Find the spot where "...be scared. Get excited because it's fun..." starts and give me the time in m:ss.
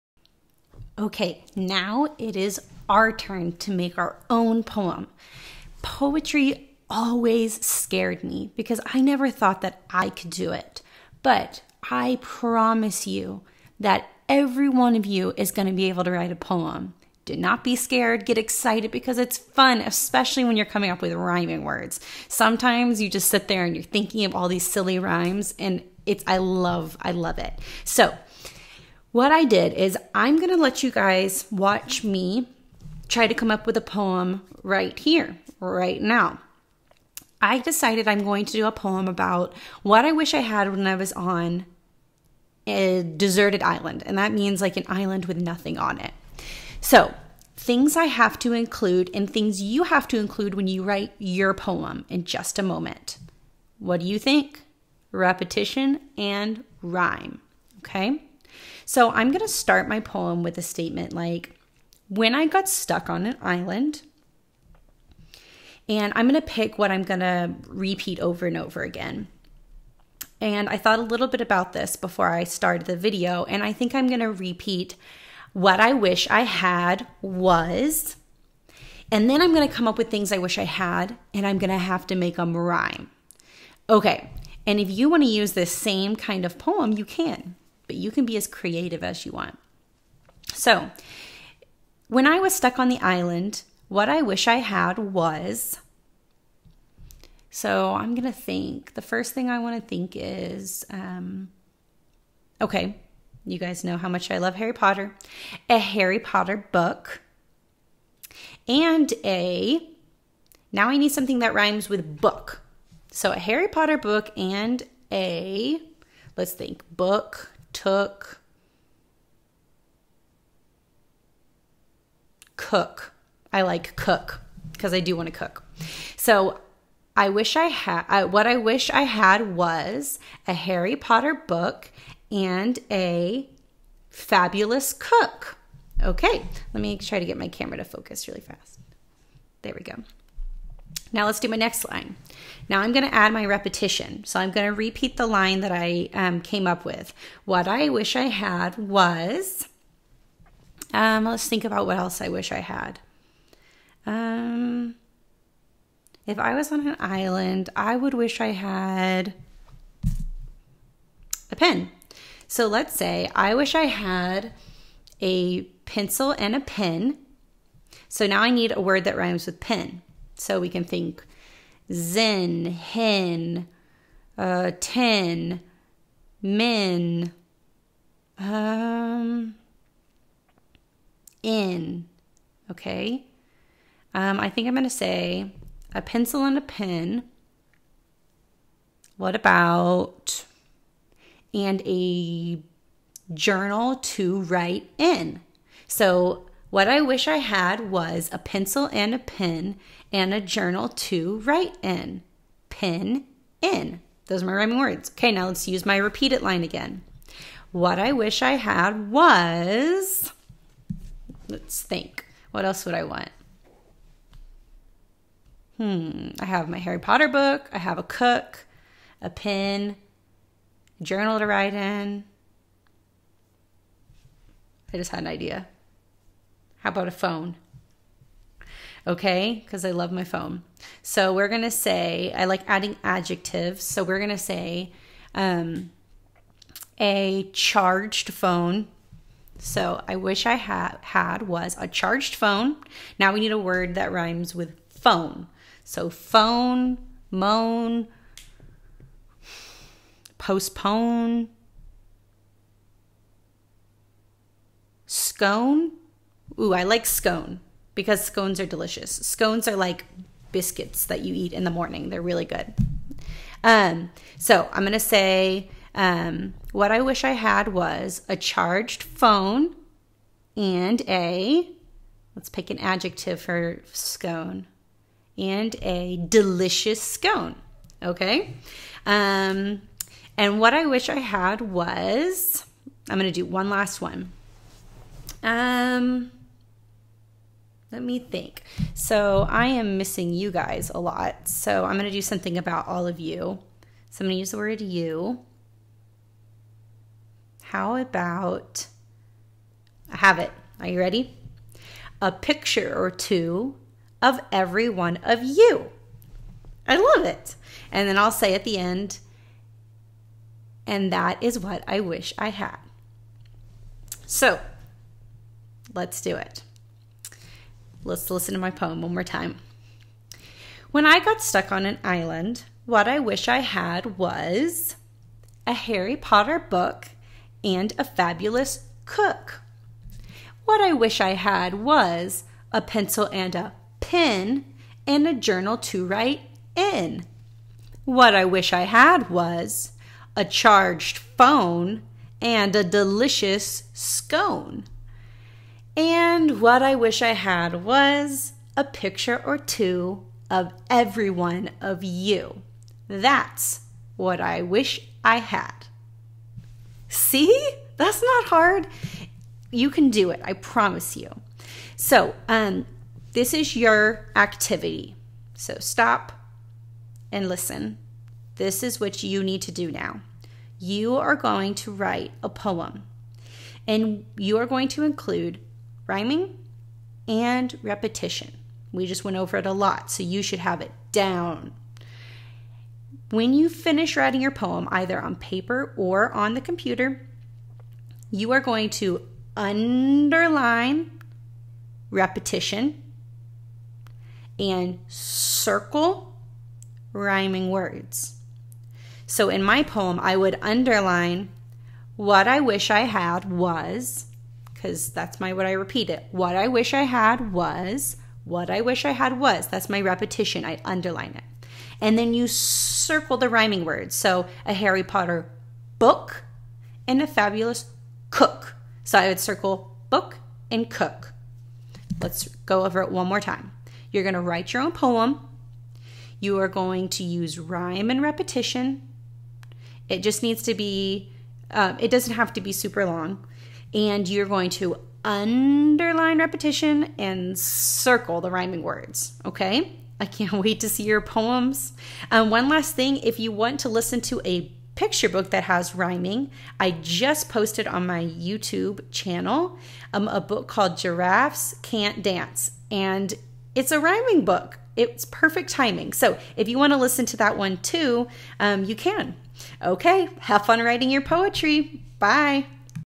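0:17.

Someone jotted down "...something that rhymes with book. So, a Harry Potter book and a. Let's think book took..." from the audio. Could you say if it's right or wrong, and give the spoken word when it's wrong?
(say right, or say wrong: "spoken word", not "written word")
right.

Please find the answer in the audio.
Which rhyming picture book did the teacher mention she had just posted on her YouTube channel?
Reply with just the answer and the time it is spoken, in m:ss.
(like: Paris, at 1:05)
Giraffes Can't Dance, at 7:30.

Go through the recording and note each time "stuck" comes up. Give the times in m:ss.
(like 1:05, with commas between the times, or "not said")
1:02, 1:32, 5:21.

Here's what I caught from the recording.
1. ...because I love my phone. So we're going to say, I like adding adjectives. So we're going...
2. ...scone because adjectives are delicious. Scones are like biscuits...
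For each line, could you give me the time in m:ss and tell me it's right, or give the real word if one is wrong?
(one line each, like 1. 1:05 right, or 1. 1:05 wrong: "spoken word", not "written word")
1. 3:49 right
2. 4:17 wrong: "scones", not "adjectives".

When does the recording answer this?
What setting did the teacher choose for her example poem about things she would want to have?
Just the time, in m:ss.
0:43.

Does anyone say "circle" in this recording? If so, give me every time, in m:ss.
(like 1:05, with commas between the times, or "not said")
6:35, 6:52, 6:59, 7:17.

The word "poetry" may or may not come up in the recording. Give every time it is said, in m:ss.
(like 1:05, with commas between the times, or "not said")
0:05, 7:41.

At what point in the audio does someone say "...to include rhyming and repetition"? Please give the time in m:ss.
6:14.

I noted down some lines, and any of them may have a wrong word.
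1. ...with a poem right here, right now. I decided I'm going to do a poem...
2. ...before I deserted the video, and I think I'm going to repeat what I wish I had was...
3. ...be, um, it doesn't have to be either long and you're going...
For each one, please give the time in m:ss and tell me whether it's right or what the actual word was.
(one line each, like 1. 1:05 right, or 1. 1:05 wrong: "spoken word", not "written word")
1. 0:33 right
2. 1:11 wrong: "started", not "deserted"
3. 7:10 wrong: "super", not "either".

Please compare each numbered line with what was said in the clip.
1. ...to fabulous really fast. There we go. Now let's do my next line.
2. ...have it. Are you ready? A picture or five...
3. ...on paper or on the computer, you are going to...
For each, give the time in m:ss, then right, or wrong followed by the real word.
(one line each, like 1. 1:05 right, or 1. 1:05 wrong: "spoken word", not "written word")
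1. 2:17 wrong: "focus", not "fabulous"
2. 5:00 wrong: "two", not "five"
3. 6:25 right.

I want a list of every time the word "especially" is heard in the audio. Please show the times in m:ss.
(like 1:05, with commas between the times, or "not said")
0:19.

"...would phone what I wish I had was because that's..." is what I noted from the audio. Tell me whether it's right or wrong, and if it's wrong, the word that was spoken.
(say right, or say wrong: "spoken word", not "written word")
wrong: "underline", not "phone".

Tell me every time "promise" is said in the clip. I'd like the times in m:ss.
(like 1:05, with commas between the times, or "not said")
0:12, 6:00.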